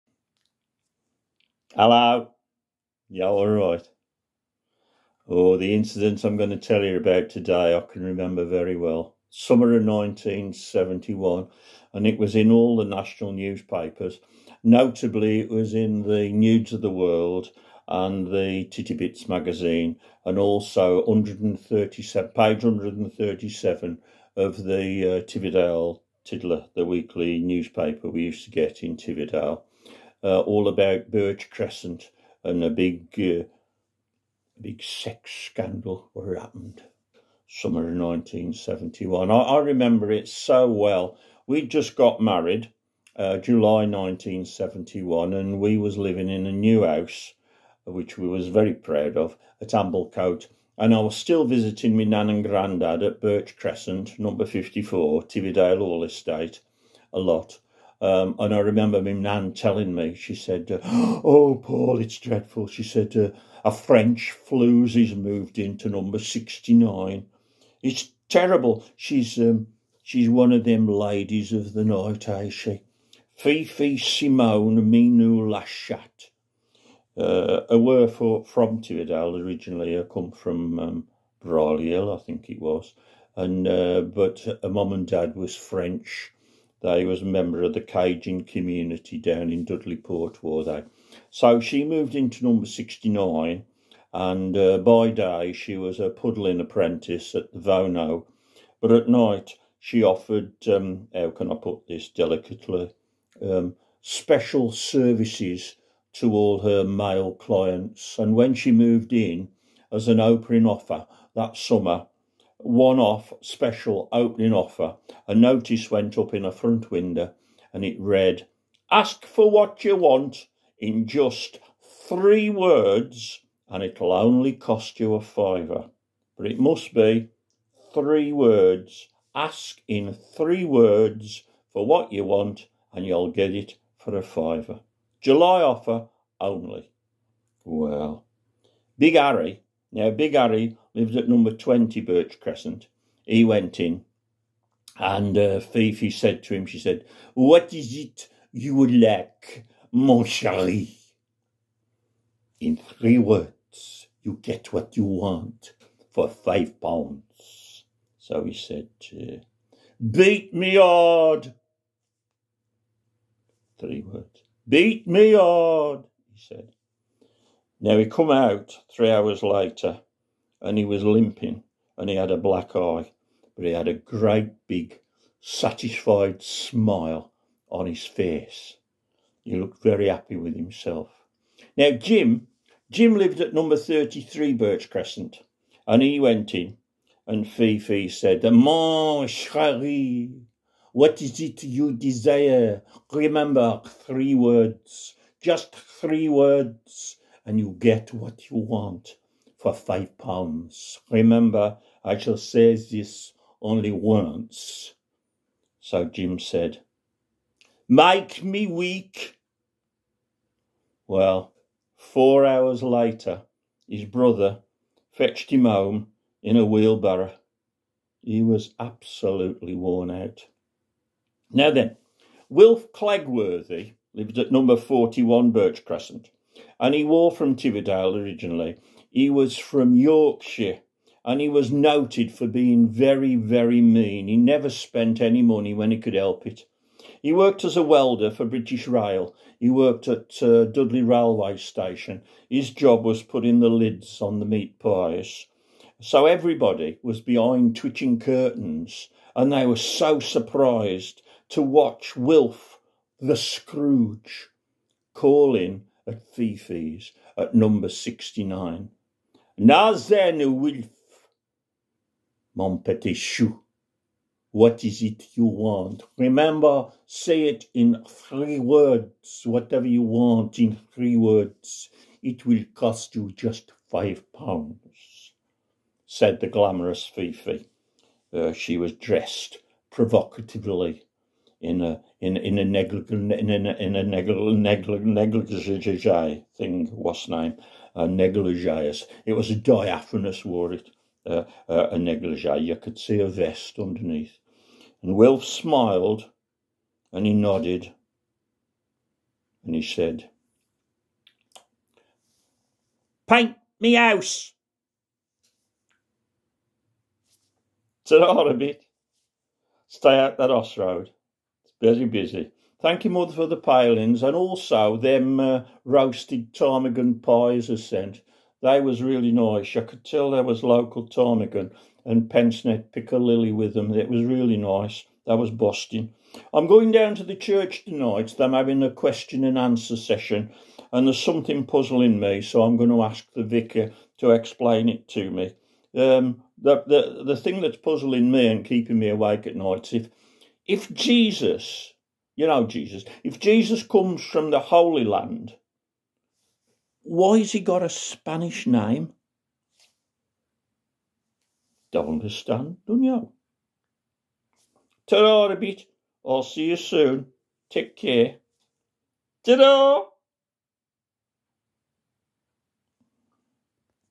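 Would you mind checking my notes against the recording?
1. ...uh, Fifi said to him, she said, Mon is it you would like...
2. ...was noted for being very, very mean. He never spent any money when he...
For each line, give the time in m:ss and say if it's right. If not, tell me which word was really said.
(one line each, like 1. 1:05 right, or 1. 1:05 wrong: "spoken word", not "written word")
1. 2:25 wrong: "What", not "Mon"
2. 3:51 right.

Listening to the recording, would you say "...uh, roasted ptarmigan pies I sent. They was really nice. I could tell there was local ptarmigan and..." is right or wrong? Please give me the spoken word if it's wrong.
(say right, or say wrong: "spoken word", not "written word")
right.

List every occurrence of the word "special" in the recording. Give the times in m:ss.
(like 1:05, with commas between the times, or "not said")
1:44, 1:53.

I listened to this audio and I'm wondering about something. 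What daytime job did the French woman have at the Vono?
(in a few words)
Puddling apprentice.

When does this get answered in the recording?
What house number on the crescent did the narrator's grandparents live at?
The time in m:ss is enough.
0:54.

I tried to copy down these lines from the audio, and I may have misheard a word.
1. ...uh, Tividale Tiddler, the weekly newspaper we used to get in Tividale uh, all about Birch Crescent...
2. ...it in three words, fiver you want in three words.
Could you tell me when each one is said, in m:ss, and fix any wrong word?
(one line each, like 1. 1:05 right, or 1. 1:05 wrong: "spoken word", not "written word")
1. 0:24 right
2. 4:27 wrong: "whatever", not "fiver".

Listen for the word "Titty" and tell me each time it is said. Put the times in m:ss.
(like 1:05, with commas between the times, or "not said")
0:18.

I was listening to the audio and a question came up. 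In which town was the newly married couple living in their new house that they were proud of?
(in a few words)
Amblecote.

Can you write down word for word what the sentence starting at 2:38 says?
So he said, uh, Beat me hard.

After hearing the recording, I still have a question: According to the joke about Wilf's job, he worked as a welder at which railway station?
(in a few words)
Dudley Railway Station.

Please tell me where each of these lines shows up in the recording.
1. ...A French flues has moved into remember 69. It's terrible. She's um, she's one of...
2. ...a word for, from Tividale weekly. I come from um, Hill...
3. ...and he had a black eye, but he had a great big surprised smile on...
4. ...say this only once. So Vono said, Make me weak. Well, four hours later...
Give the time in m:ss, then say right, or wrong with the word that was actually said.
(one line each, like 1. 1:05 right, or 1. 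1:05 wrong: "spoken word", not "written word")
1. 1:03 wrong: "number", not "remember"
2. 1:17 wrong: "originally", not "weekly"
3. 2:51 wrong: "satisfied", not "surprised"
4. 3:22 wrong: "Jim", not "Vono".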